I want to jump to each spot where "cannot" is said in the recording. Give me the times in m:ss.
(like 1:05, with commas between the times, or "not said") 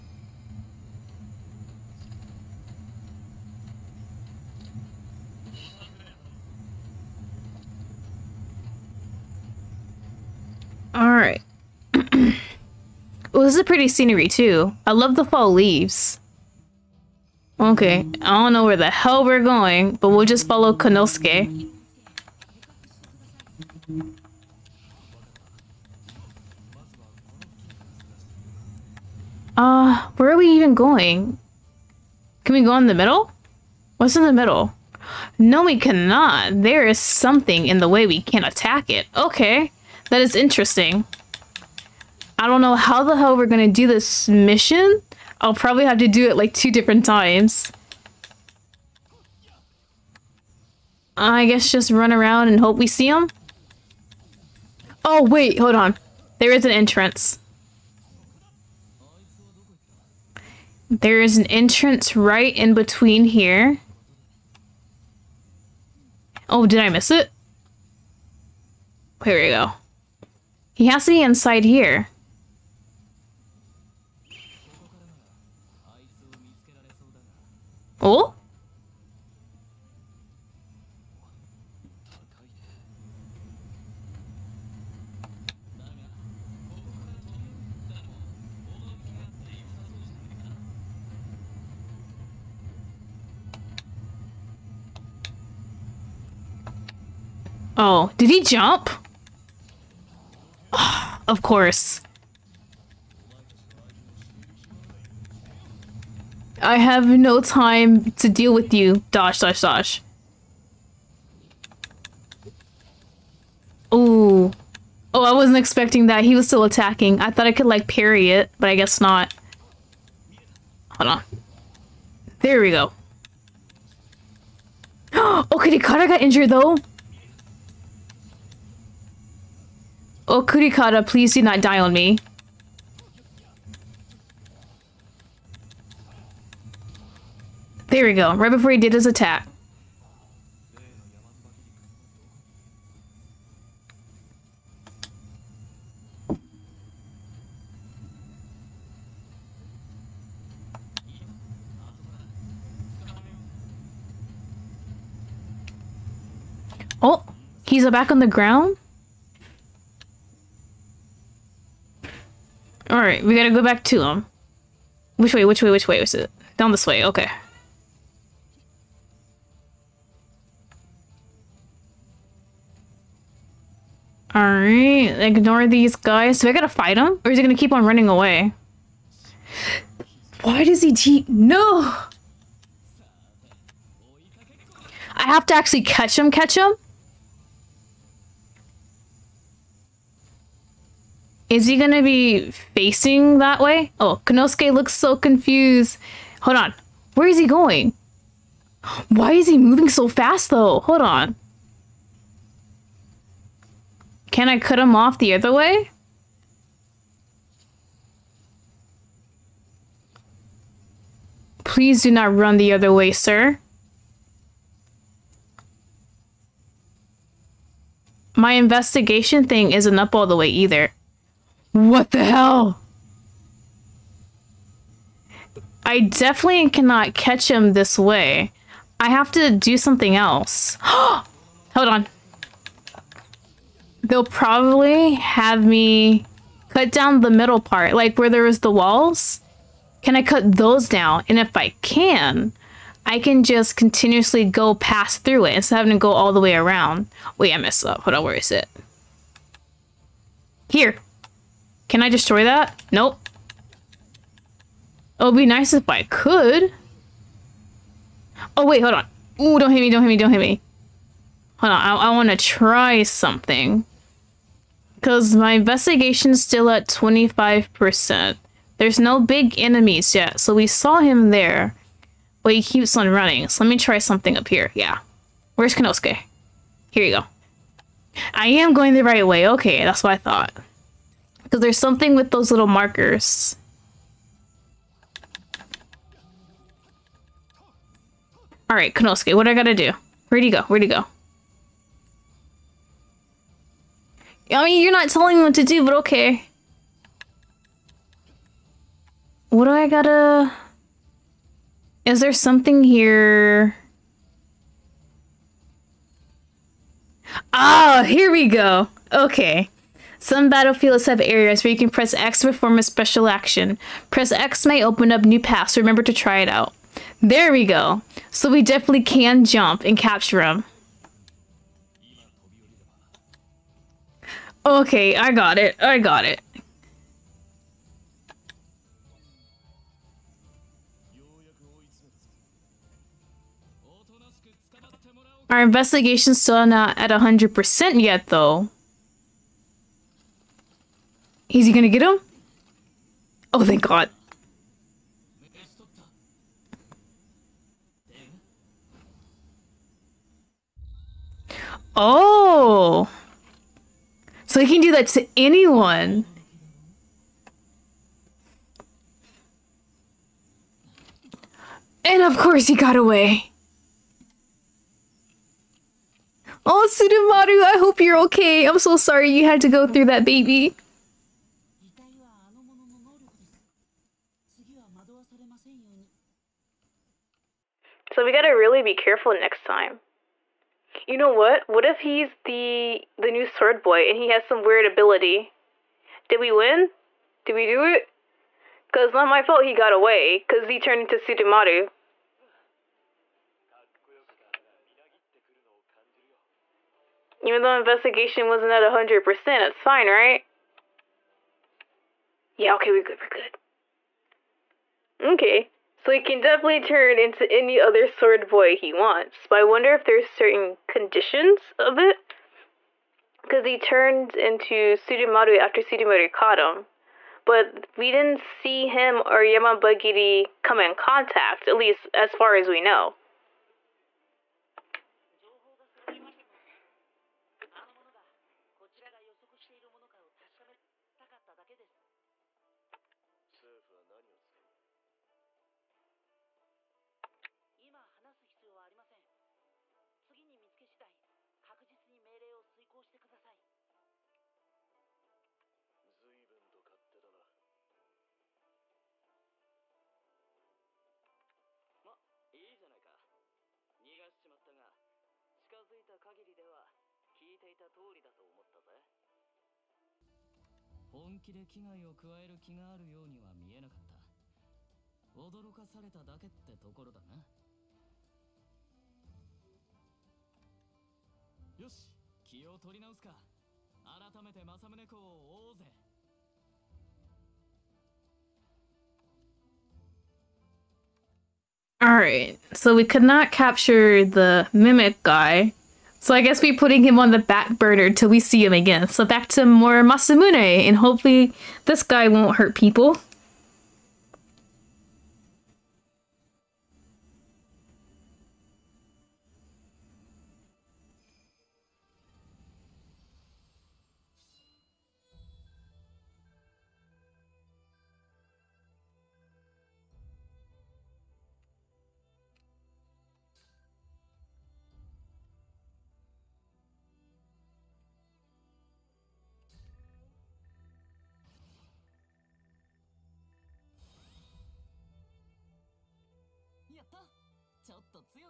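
0:35, 3:46.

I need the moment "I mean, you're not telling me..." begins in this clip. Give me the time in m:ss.
4:54.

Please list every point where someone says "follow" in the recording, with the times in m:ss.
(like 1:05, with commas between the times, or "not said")
0:20.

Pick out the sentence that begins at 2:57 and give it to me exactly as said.
Or is he gonna keep on running away?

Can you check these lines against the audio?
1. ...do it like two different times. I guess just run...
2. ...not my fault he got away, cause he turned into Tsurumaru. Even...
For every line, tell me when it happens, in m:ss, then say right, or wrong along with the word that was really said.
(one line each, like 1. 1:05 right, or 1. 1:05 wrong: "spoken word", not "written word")
1. 0:46 right
2. 6:29 right.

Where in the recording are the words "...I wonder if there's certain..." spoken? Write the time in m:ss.
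6:49.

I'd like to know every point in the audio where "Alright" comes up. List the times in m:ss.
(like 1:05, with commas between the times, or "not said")
2:42, 2:54, 4:48.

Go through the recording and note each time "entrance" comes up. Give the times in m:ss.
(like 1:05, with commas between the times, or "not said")
0:56, 1:01.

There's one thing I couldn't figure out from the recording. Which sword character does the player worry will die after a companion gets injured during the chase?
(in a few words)
Kurikara.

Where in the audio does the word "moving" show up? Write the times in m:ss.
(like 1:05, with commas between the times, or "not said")
3:19.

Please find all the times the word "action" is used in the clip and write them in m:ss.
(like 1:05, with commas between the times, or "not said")
5:13.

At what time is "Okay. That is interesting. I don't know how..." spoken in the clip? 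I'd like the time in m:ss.
0:39.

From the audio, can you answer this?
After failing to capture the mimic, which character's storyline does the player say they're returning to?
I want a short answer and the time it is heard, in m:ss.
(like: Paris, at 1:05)
Masamune, at 8:10.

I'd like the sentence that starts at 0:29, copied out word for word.
Uh, where are we even going?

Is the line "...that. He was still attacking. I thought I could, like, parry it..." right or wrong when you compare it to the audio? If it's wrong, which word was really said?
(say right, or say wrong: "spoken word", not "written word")
right.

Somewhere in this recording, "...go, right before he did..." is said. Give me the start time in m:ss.
2:18.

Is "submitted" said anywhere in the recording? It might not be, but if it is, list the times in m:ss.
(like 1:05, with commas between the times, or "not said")
not said.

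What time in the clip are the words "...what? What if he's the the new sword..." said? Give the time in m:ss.
6:21.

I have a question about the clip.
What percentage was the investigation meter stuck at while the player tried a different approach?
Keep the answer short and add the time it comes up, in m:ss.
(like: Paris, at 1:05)
25%, at 4:26.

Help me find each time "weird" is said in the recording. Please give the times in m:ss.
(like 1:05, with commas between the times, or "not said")
6:24.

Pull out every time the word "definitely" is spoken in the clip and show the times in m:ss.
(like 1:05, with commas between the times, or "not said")
3:45, 5:18, 6:46.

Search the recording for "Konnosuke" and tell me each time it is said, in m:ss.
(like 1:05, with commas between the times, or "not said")
3:14, 4:35, 4:48.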